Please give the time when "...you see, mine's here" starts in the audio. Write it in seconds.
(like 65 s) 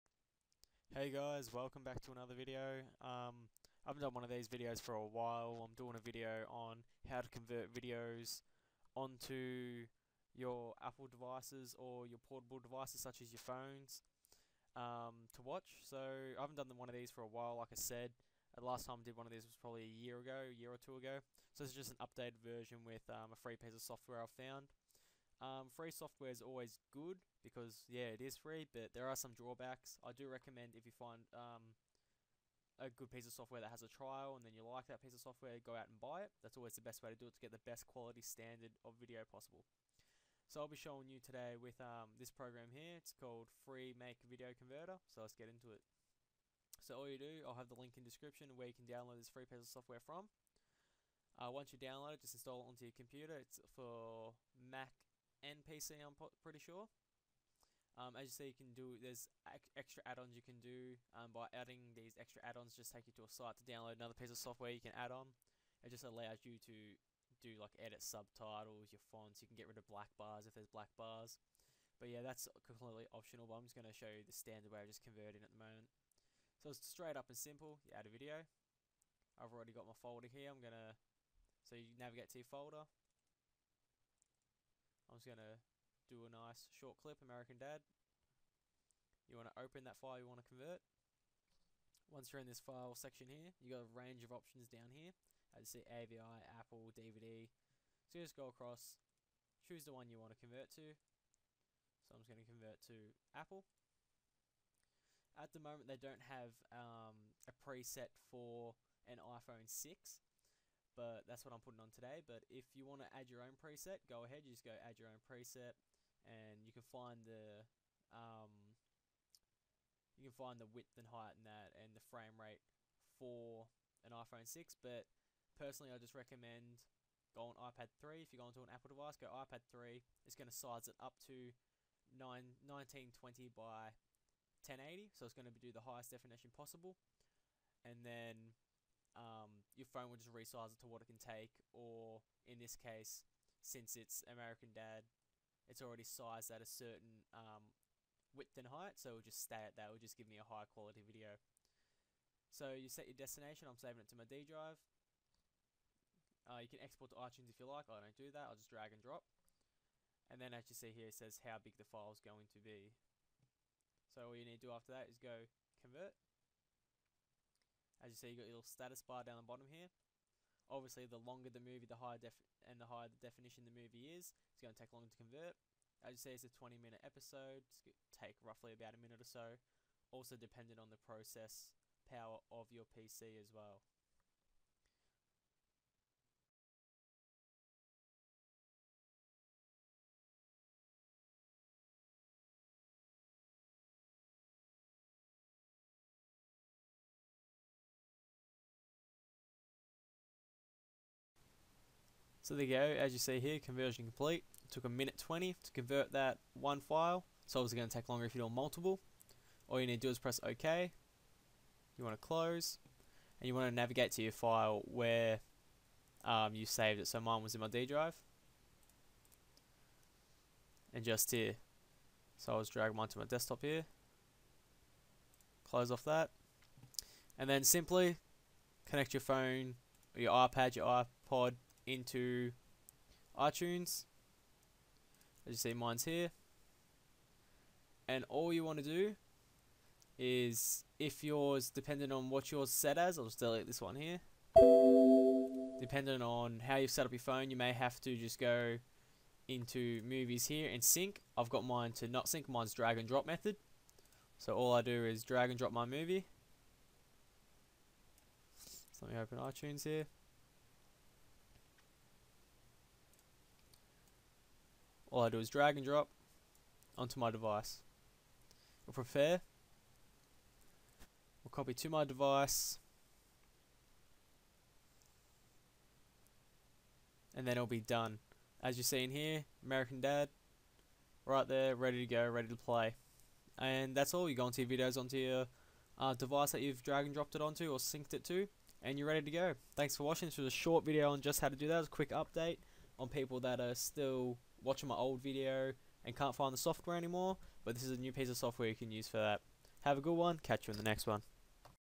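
235 s.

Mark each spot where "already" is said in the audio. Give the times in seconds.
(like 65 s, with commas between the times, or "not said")
79 s, 145 s.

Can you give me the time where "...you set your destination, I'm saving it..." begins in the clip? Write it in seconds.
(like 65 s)
152 s.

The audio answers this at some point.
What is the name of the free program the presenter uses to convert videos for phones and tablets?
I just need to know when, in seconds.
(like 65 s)
43 s.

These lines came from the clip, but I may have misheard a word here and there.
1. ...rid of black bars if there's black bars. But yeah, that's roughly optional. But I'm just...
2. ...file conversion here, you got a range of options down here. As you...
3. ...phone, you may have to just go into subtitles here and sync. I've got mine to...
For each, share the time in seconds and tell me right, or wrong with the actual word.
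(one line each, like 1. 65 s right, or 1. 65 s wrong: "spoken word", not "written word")
1. 69 s wrong: "completely", not "roughly"
2. 92 s wrong: "section", not "conversion"
3. 247 s wrong: "movies", not "subtitles".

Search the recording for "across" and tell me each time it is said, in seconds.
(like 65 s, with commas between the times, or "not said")
98 s.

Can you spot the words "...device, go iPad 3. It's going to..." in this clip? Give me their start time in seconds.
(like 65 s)
128 s.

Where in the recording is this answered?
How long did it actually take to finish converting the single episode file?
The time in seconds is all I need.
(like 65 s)
204 s.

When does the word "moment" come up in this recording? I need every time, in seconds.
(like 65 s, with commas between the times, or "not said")
75 s, 105 s.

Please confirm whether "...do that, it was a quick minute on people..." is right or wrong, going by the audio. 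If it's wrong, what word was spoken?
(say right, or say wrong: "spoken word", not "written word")
wrong: "update", not "minute".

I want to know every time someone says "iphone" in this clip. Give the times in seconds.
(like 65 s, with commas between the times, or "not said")
109 s, 124 s.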